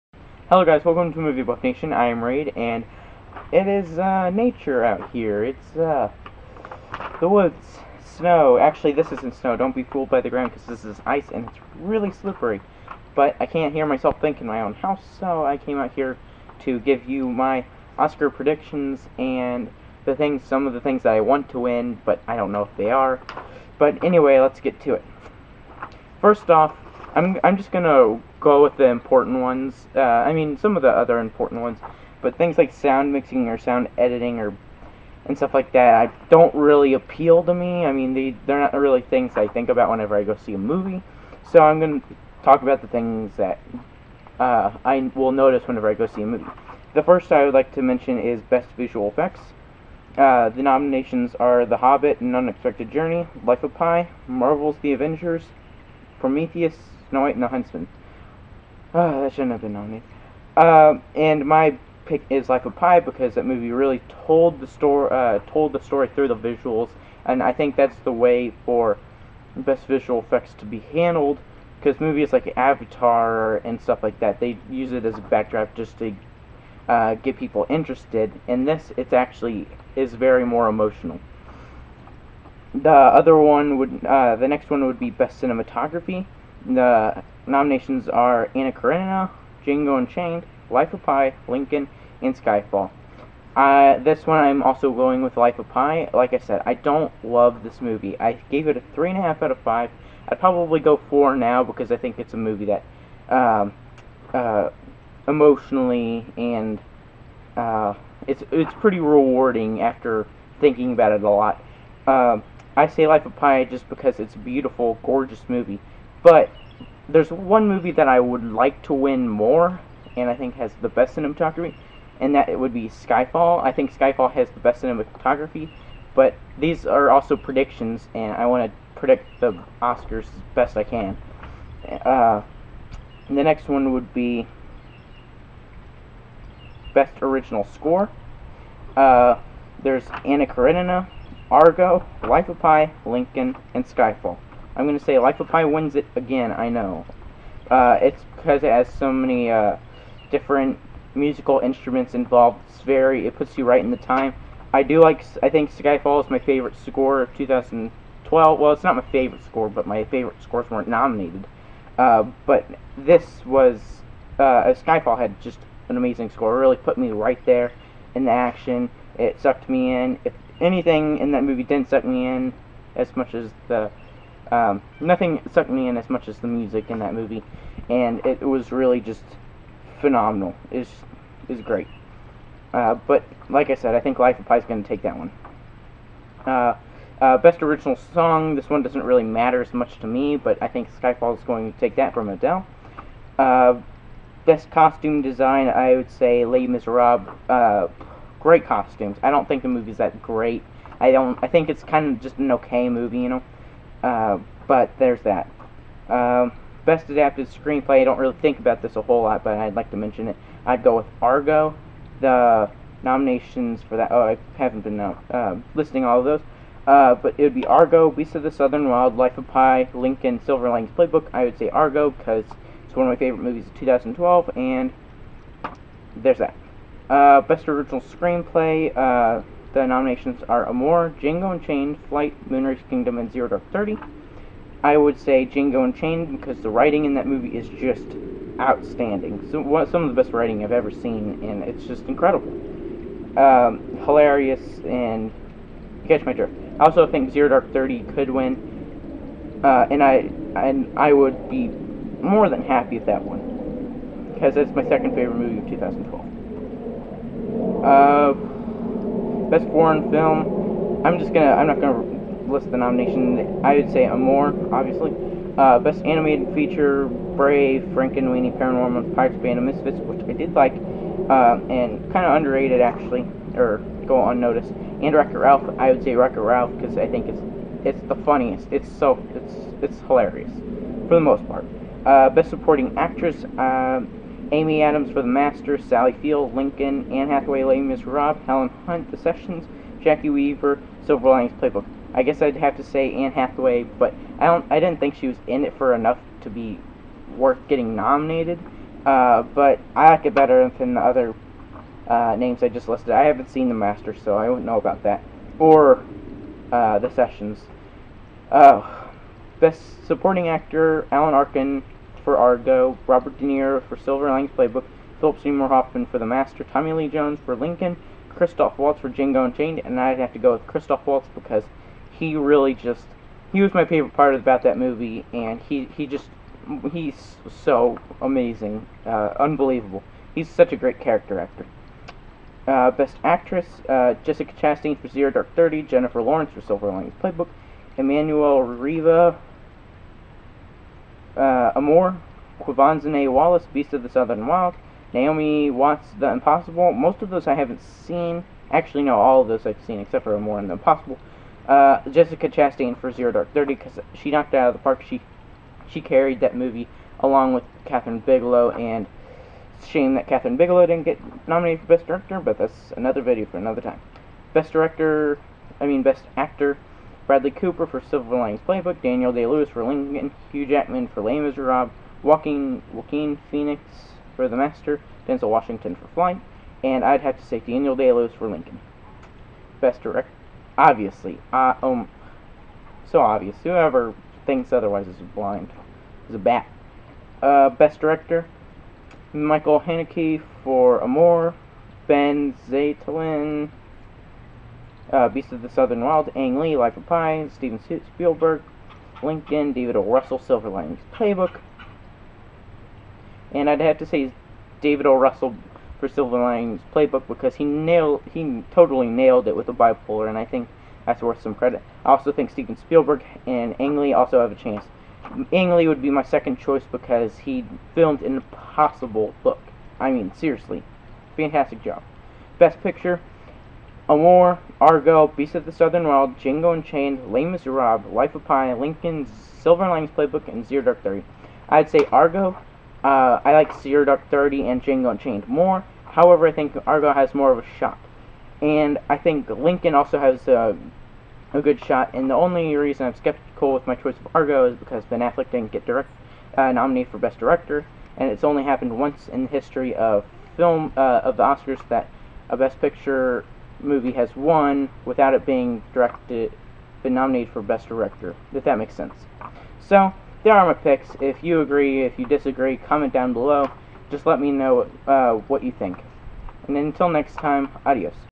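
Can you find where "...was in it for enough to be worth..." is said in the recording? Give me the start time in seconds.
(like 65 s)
295 s.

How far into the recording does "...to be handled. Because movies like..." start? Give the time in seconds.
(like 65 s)
70 s.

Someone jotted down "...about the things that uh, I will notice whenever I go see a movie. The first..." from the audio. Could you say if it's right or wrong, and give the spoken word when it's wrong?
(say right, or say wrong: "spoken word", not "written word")
right.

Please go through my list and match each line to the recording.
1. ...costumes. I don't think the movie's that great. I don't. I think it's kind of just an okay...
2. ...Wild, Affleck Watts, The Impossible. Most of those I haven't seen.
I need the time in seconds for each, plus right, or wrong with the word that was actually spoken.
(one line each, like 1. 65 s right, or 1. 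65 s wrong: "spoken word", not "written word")
1. 198 s right
2. 344 s wrong: "Naomi", not "Affleck".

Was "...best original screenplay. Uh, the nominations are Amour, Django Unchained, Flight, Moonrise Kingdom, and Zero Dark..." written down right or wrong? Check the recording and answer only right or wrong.
right.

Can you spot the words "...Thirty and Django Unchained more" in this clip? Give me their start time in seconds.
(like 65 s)
434 s.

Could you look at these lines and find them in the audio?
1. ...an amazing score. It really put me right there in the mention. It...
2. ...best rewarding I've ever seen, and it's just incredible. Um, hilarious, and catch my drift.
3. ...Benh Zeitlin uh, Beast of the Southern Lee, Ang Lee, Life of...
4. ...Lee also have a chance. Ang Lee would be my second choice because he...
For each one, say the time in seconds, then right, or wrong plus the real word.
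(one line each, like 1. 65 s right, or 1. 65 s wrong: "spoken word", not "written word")
1. 165 s wrong: "action", not "mention"
2. 240 s wrong: "writing", not "rewarding"
3. 392 s wrong: "Wild", not "Lee"
4. 413 s right.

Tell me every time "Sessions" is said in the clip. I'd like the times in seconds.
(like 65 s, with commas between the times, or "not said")
289 s, 307 s.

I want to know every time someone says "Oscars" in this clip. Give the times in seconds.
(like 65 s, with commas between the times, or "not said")
17 s, 129 s, 451 s.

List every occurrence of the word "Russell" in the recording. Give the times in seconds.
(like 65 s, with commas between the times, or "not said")
400 s, 405 s.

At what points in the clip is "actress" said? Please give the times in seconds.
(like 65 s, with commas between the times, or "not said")
282 s, 333 s.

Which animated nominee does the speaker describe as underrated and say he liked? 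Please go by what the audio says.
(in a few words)
Pirates, Band of Misfits.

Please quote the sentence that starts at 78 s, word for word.
And this, it's actually is very more emotional.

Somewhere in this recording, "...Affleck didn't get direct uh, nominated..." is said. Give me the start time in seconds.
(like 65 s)
445 s.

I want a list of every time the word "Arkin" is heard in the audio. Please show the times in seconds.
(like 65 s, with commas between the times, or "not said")
311 s.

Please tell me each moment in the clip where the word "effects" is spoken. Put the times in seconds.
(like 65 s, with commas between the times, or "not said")
49 s, 70 s.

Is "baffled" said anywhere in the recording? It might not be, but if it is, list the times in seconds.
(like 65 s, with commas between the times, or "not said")
not said.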